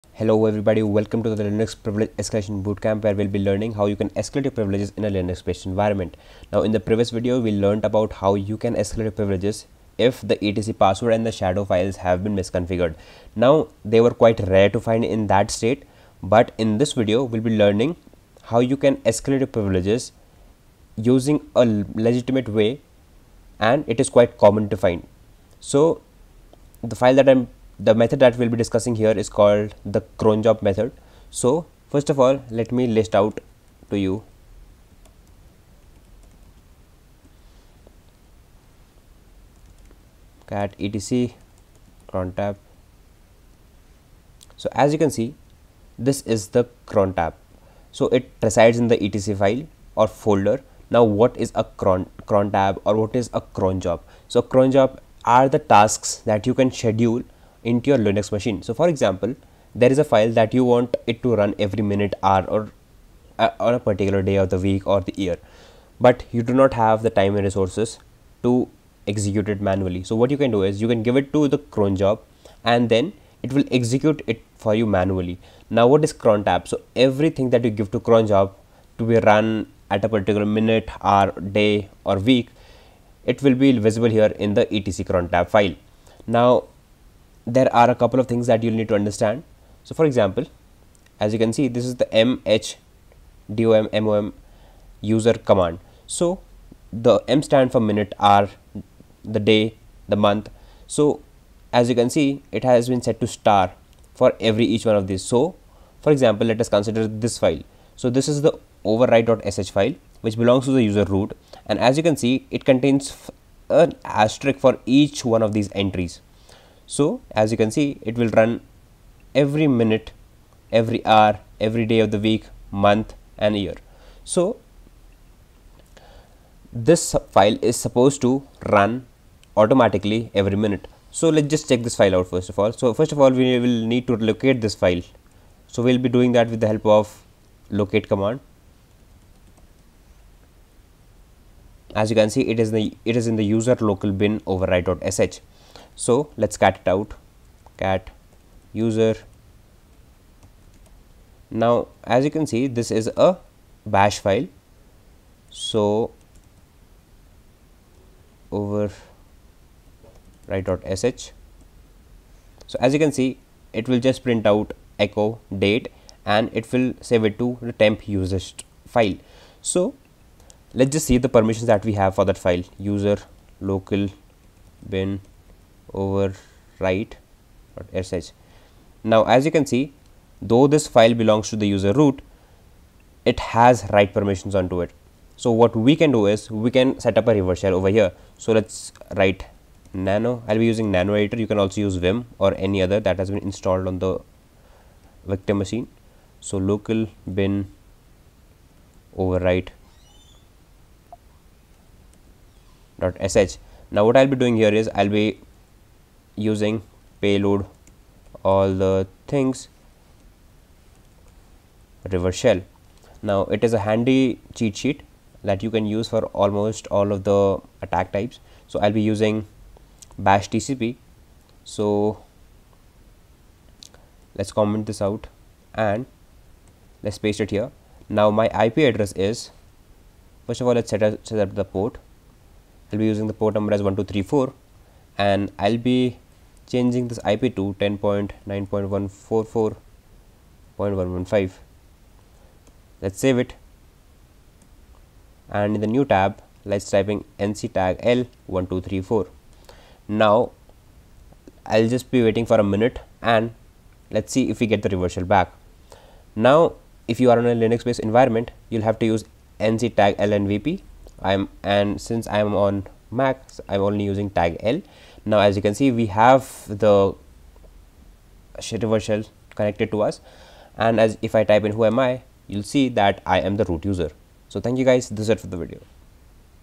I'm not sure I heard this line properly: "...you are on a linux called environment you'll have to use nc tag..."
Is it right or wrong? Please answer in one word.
wrong.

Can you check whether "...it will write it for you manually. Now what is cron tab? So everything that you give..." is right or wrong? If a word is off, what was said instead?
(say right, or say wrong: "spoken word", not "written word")
wrong: "execute", not "write".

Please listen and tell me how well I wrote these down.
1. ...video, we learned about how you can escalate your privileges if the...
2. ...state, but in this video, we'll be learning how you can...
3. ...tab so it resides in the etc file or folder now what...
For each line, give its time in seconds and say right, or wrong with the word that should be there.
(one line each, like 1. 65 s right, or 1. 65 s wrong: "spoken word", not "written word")
1. 7 s right
2. 15 s right
3. 47 s right.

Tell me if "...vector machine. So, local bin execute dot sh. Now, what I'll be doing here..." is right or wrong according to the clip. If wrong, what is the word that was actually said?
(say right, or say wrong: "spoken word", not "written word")
wrong: "overwrite", not "execute".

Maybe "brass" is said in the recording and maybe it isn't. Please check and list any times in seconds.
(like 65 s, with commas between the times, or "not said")
not said.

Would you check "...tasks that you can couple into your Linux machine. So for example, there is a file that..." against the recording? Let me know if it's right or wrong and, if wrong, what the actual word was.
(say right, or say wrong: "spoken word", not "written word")
wrong: "schedule", not "couple".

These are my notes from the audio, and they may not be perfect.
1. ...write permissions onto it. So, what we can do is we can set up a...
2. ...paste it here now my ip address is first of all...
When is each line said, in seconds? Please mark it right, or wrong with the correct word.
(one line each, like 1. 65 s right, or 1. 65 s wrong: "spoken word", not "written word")
1. 183 s right
2. 227 s right.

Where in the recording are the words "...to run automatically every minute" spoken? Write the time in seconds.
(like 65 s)
128 s.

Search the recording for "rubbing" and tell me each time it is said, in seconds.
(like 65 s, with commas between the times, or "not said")
not said.